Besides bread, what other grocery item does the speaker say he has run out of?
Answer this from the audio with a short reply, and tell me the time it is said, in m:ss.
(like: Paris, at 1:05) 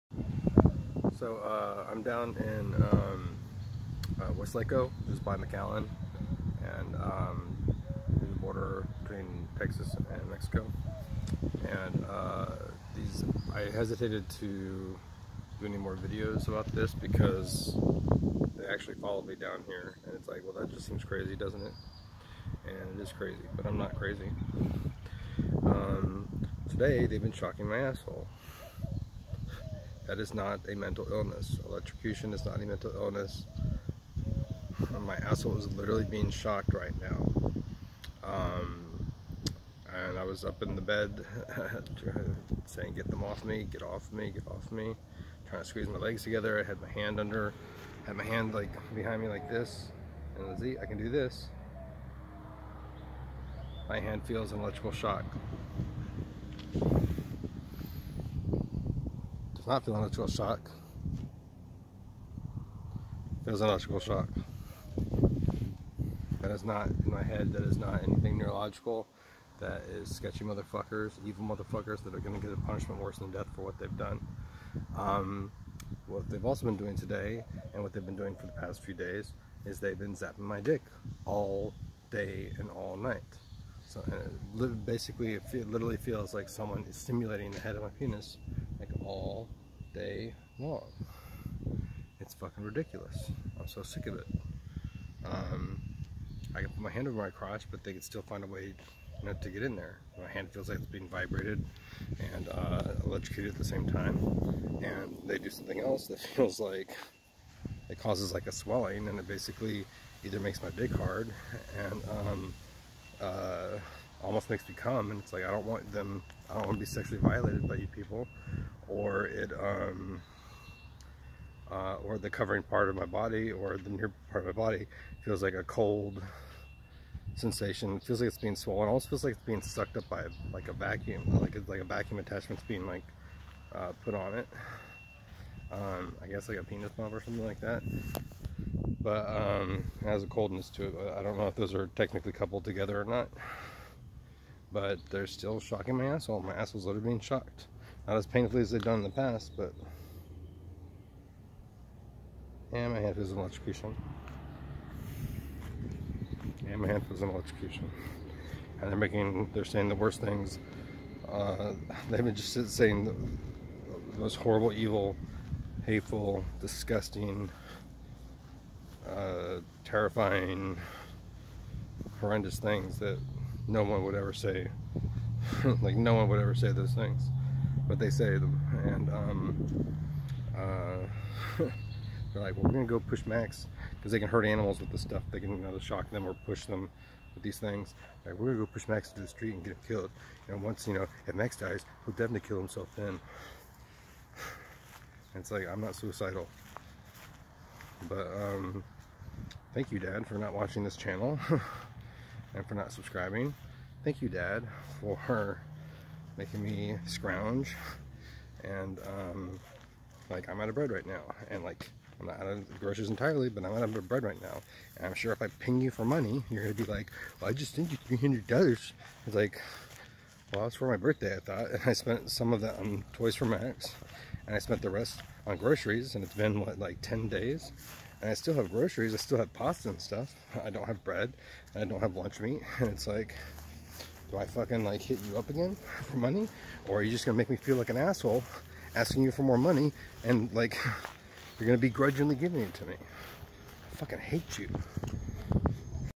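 Lunch meat, at 3:52.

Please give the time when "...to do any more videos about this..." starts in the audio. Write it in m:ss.
0:14.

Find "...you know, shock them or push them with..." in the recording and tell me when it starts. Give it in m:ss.
3:05.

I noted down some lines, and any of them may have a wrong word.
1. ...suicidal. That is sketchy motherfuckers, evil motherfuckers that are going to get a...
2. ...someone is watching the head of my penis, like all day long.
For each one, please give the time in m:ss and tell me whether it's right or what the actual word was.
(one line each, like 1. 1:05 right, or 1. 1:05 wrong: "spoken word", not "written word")
1. 1:08 wrong: "neurological", not "suicidal"
2. 1:26 wrong: "stimulating", not "watching".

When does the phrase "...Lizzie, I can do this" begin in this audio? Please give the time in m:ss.
0:50.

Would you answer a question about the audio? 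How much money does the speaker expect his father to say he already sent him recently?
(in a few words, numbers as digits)
$300.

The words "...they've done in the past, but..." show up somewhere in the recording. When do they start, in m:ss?
2:28.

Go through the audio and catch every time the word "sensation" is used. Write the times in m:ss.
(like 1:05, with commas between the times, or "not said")
2:07.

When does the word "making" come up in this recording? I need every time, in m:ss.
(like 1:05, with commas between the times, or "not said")
2:38, 3:26.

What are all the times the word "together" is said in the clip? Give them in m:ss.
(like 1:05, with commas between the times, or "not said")
0:46, 2:22.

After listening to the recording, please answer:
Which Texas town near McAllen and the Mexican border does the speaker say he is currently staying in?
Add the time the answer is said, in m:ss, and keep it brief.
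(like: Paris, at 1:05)
Weslaco, at 0:04.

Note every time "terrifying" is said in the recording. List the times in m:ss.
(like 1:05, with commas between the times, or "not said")
2:49.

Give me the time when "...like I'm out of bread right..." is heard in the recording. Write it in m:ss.
3:30.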